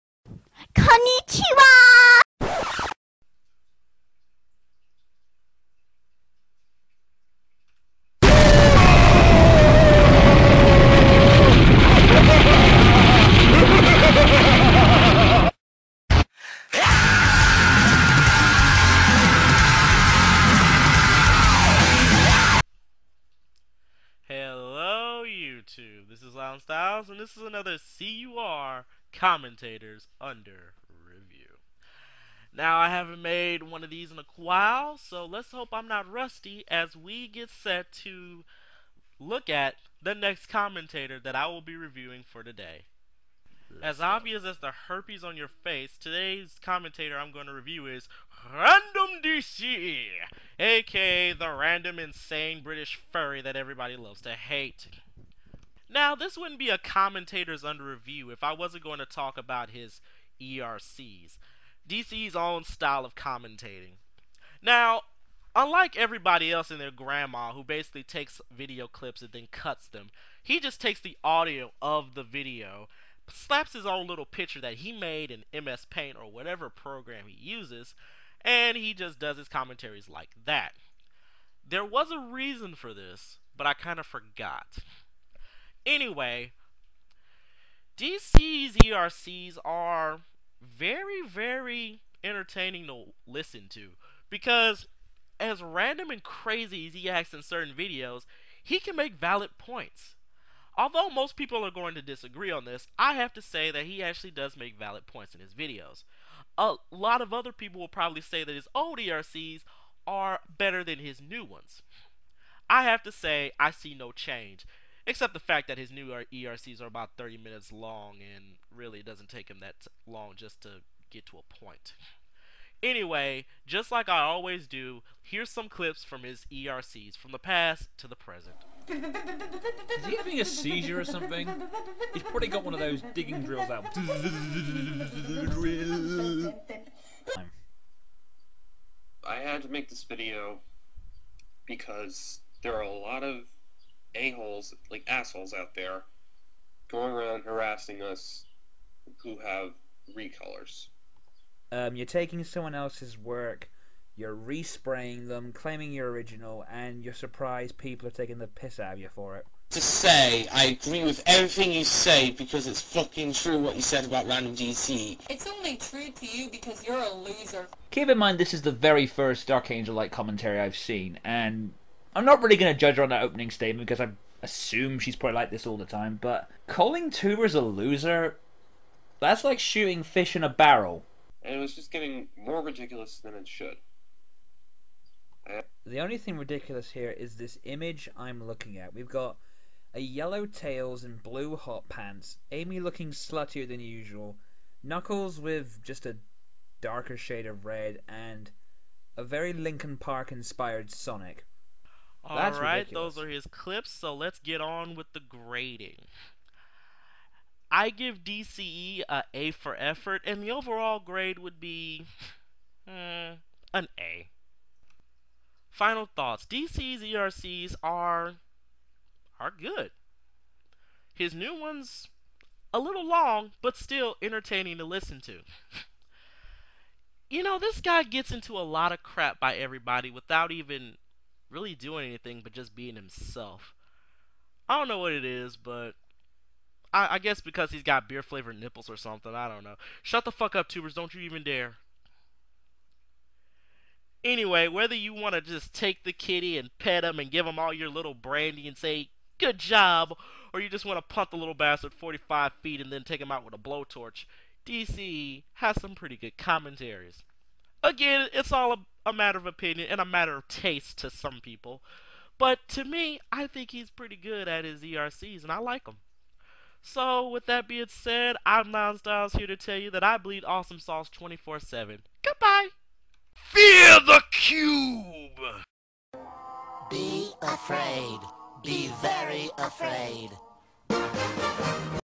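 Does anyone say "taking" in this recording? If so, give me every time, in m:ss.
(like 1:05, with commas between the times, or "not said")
2:32, 2:38.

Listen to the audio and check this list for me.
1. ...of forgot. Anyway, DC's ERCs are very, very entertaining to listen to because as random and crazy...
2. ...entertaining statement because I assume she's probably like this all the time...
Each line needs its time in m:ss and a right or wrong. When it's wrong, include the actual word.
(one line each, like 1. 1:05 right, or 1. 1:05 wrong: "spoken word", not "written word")
1. 1:23 right
2. 2:53 wrong: "opening", not "entertaining".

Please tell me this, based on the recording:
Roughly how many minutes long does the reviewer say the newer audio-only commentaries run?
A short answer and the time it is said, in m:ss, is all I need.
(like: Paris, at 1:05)
30 minutes, at 1:57.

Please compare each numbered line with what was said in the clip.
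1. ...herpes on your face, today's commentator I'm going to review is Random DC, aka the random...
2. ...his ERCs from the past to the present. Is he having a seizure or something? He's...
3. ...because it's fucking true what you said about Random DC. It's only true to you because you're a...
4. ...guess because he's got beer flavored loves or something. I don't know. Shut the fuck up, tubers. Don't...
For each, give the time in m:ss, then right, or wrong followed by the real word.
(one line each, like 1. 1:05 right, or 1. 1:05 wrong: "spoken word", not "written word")
1. 0:44 right
2. 2:06 right
3. 2:42 right
4. 3:57 wrong: "nipples", not "loves".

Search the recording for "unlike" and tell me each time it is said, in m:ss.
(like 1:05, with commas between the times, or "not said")
1:05.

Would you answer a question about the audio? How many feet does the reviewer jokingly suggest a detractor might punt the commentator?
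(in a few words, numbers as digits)
45 feet.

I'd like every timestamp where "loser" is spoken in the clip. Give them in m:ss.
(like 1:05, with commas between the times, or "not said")
2:47, 2:57.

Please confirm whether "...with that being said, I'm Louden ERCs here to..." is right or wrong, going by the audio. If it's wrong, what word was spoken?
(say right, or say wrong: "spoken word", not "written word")
wrong: "Styles", not "ERCs".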